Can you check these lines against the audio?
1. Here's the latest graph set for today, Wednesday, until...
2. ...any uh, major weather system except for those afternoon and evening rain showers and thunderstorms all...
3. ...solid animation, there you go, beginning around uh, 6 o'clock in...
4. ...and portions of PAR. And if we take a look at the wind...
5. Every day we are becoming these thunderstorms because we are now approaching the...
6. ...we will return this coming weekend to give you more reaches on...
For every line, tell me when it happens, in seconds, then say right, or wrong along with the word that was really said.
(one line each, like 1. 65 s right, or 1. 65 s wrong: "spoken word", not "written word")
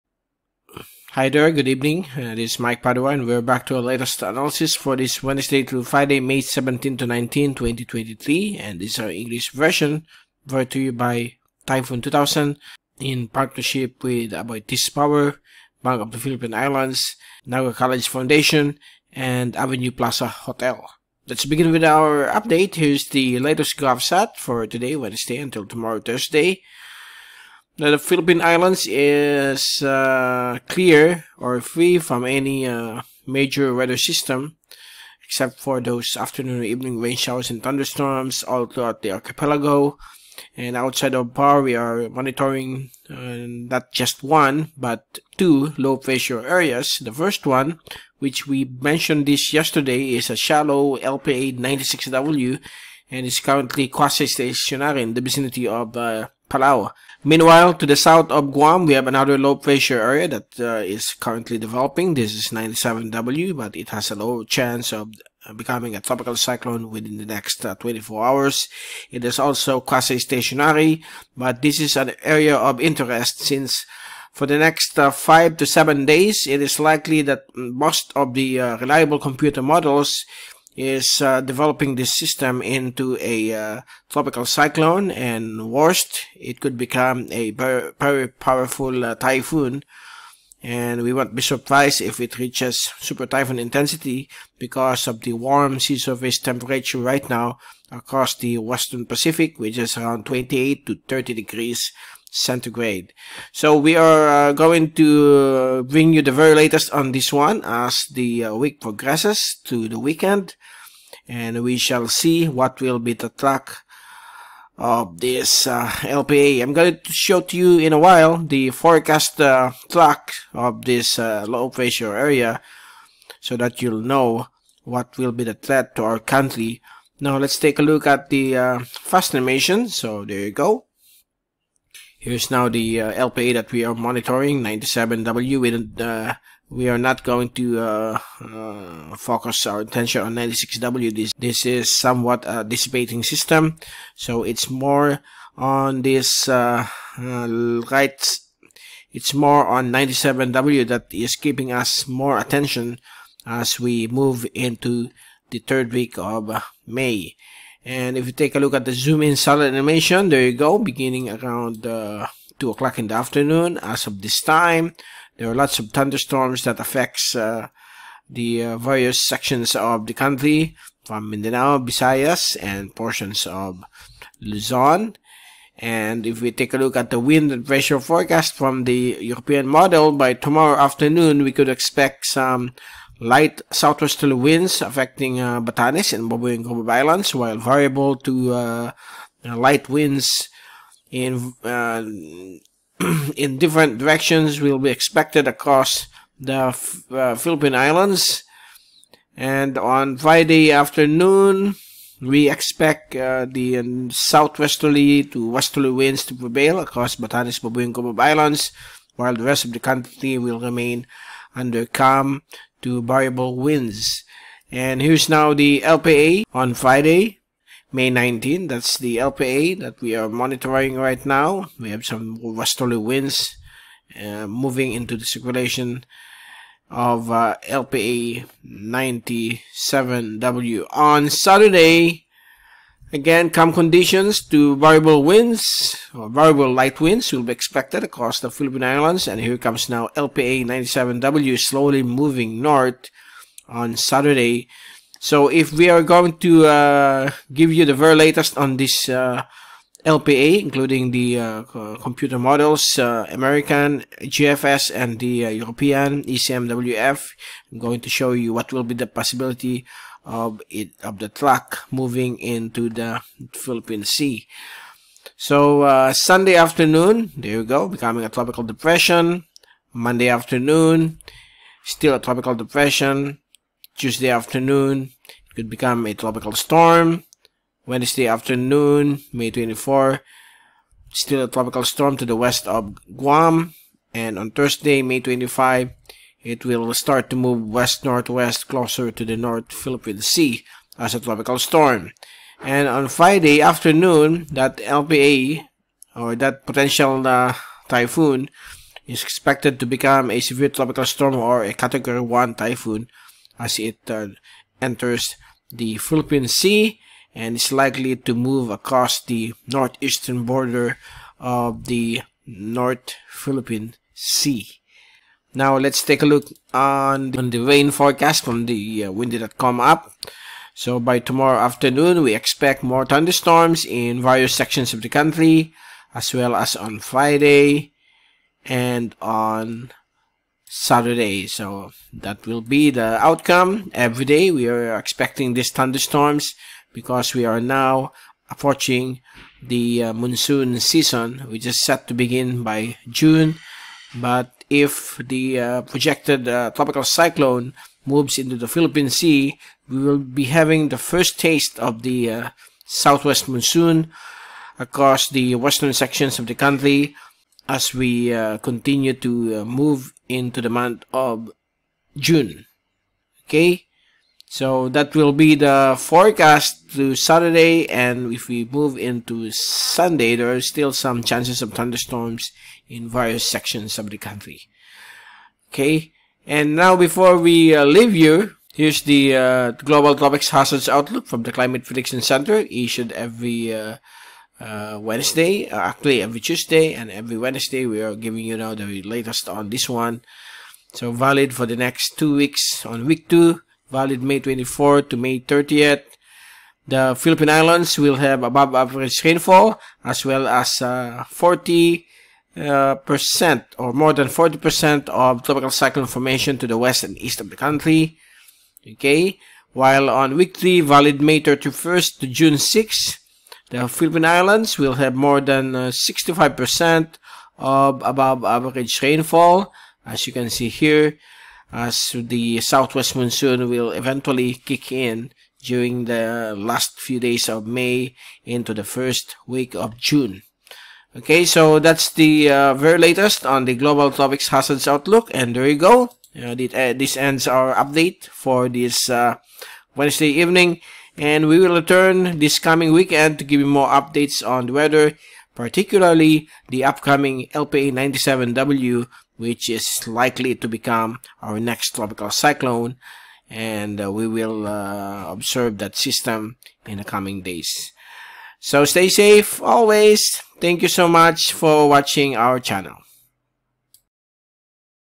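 1. 22 s right
2. 32 s right
3. 159 s wrong: "2", not "6"
4. 172 s wrong: "Luzon", not "PAR"
5. 333 s wrong: "expecting", not "becoming"
6. 441 s wrong: "updates", not "reaches".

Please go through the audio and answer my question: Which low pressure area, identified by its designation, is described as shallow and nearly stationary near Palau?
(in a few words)
96W.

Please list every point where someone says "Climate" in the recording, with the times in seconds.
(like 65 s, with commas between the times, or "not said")
381 s.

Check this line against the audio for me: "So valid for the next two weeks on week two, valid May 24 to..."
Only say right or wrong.
right.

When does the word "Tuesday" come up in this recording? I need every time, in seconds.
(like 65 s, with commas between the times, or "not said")
273 s, 386 s.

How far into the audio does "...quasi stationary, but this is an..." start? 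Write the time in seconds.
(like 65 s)
69 s.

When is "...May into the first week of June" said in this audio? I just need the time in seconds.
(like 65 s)
427 s.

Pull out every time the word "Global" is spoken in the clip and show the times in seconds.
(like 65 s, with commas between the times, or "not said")
379 s, 433 s.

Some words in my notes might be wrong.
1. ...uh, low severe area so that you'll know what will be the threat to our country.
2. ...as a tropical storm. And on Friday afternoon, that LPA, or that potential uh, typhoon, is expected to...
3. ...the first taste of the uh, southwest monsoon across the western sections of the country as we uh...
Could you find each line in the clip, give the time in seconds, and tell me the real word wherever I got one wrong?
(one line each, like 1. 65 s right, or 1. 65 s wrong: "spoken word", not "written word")
1. 121 s wrong: "pressure", not "severe"
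2. 290 s right
3. 350 s right.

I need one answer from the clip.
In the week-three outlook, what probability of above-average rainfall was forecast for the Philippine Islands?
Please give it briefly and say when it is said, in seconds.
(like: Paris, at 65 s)
More than 65%, at 415 s.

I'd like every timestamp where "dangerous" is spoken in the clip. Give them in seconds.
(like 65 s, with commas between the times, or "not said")
not said.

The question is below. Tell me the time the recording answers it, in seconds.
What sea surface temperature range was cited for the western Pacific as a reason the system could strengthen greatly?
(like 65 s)
100 s.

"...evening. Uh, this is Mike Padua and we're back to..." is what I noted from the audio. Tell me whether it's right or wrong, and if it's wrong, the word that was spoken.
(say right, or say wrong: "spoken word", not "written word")
right.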